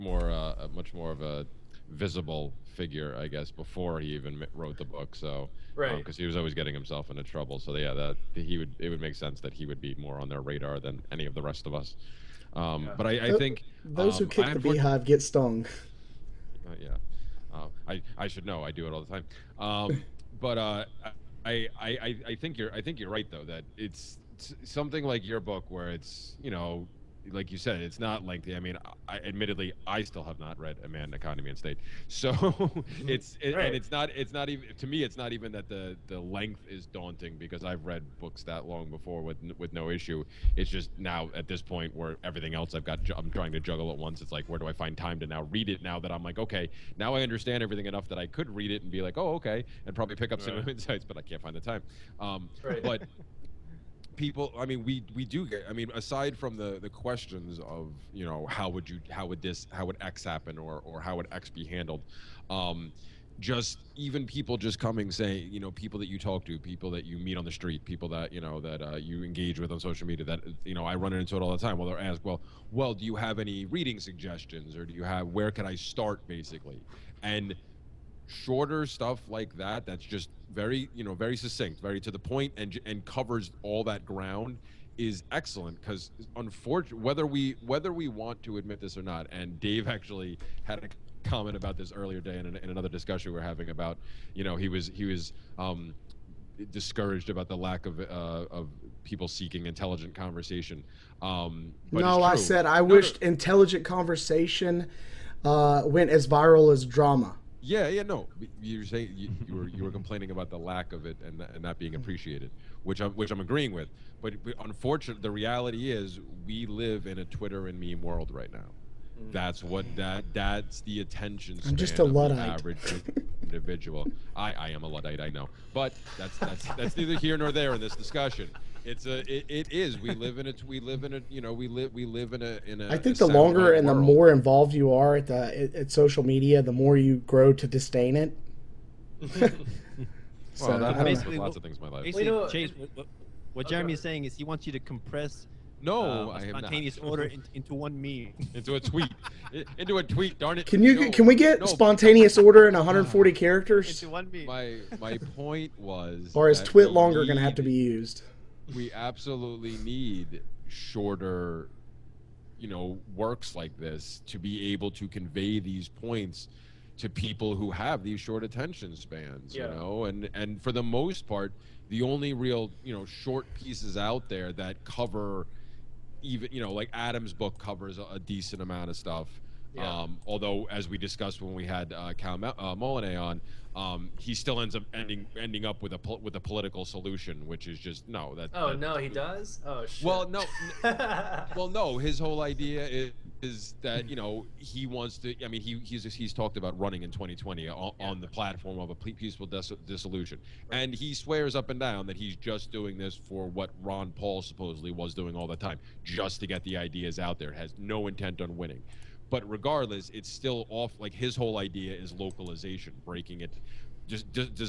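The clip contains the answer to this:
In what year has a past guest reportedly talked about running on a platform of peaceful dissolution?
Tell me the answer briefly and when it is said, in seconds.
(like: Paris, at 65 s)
2020, at 197 s.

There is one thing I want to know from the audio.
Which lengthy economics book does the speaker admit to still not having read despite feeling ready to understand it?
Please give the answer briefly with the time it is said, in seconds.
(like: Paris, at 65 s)
Man, Economy, and State, at 30 s.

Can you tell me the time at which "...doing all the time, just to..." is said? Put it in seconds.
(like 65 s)
205 s.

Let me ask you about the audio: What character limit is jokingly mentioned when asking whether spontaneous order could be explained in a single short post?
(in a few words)
140.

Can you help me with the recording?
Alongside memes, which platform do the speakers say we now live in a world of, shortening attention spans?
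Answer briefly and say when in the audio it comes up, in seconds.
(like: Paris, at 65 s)
Twitter, at 117 s.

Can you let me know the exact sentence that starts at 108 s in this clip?
You're saying you, you, were you were complaining about the lack of it and, and not being mm-hmm.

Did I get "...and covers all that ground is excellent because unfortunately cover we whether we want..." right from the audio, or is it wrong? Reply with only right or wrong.
wrong.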